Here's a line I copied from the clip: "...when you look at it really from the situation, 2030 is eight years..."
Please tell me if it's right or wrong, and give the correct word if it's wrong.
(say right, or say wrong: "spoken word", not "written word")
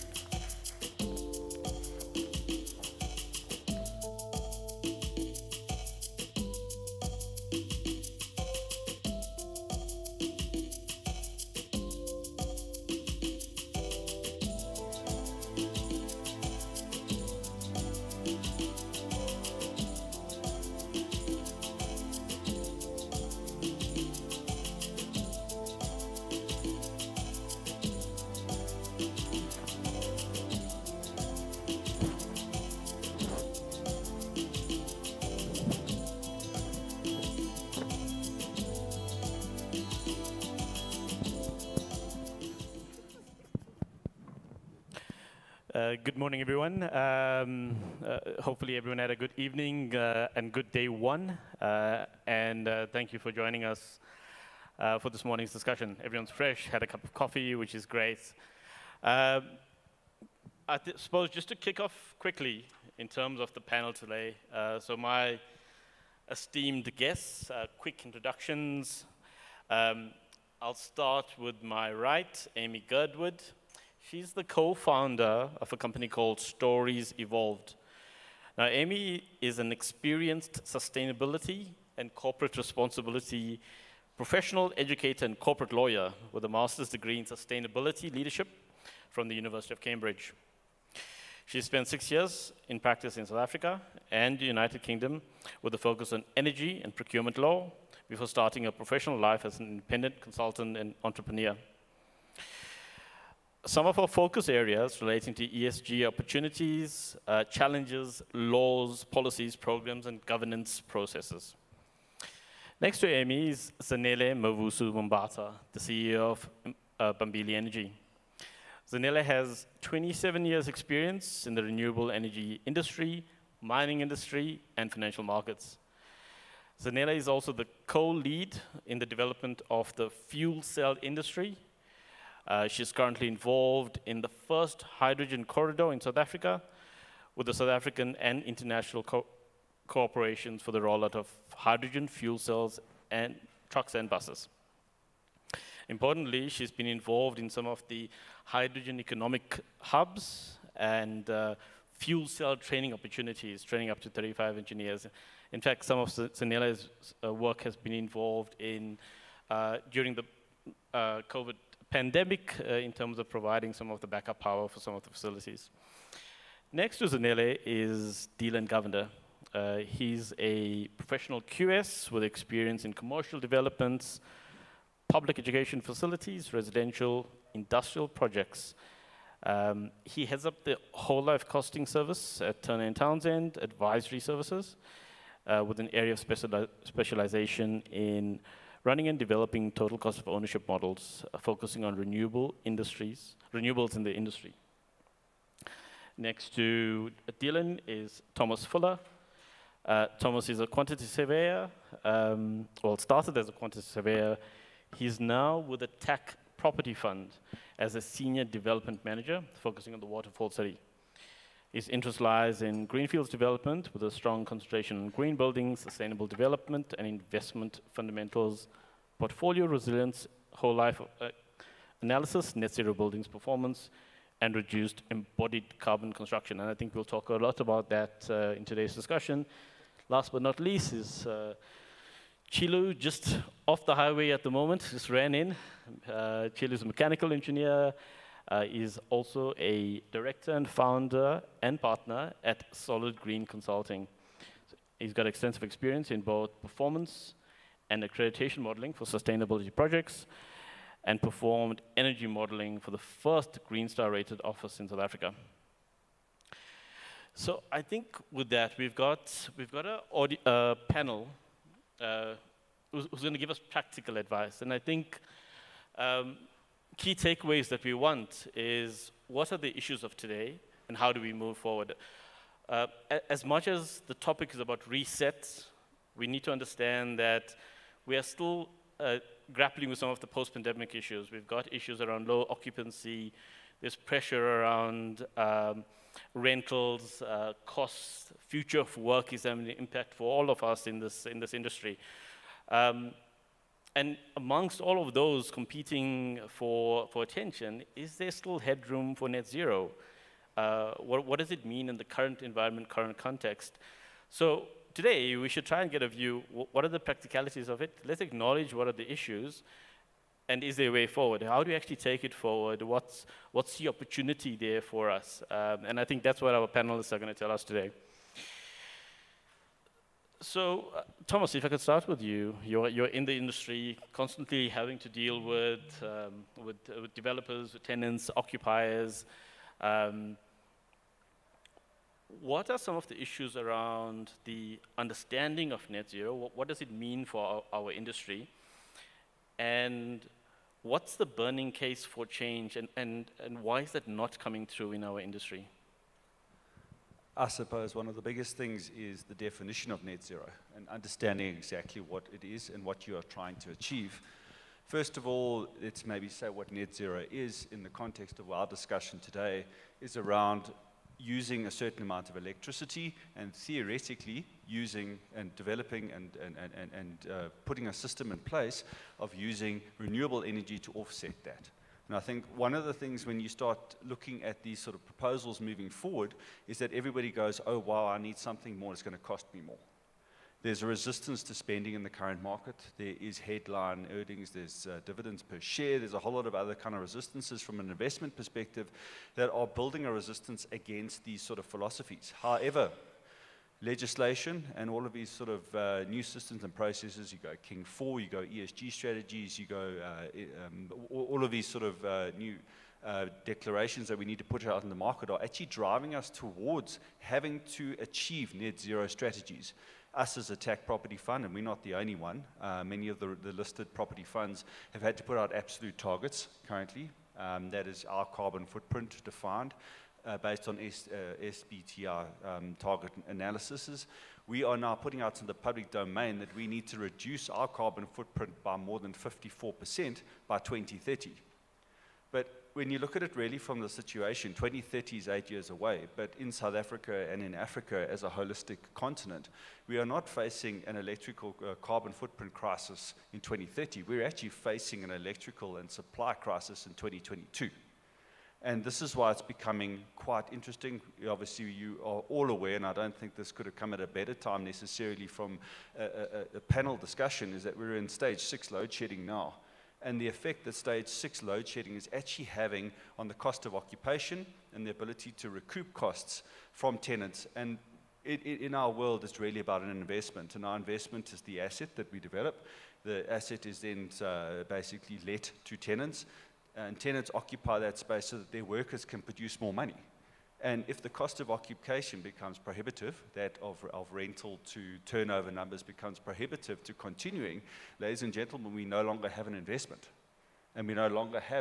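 right.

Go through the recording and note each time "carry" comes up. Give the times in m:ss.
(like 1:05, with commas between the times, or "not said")
not said.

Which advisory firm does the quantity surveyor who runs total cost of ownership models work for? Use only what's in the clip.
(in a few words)
Turner and Townsend.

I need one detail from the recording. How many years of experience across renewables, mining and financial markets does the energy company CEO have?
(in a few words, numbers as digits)
27.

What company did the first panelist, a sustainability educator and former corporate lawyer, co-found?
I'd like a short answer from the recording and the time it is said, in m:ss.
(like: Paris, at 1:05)
Stories Evolved, at 1:16.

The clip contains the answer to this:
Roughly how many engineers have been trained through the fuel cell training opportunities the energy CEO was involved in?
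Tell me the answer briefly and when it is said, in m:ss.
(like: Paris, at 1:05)
35, at 2:34.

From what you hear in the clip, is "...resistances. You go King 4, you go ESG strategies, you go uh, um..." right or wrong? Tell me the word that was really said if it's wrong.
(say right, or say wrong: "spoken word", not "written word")
wrong: "processes", not "resistances".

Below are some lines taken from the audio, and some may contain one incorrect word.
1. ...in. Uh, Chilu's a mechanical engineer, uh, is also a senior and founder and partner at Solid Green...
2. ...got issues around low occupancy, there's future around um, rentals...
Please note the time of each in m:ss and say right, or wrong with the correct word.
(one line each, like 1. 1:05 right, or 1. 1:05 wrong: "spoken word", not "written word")
1. 3:55 wrong: "director", not "senior"
2. 4:41 wrong: "pressure", not "future".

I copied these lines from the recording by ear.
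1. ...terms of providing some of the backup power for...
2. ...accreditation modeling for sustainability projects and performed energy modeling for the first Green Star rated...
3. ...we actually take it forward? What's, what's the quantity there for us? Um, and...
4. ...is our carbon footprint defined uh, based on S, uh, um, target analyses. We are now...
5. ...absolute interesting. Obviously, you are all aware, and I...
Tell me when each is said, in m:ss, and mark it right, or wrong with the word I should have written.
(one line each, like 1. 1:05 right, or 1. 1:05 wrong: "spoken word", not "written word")
1. 2:42 right
2. 4:08 right
3. 5:11 wrong: "opportunity", not "quantity"
4. 6:57 right
5. 7:30 wrong: "quite", not "absolute".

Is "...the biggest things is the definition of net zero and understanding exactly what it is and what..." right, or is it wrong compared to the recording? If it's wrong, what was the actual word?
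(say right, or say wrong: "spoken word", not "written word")
right.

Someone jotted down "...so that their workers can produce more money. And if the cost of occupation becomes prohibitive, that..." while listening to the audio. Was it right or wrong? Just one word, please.
right.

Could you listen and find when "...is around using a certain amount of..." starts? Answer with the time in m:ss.
5:59.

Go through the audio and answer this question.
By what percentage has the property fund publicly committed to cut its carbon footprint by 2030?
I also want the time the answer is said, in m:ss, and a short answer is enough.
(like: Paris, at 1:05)
54%, at 7:09.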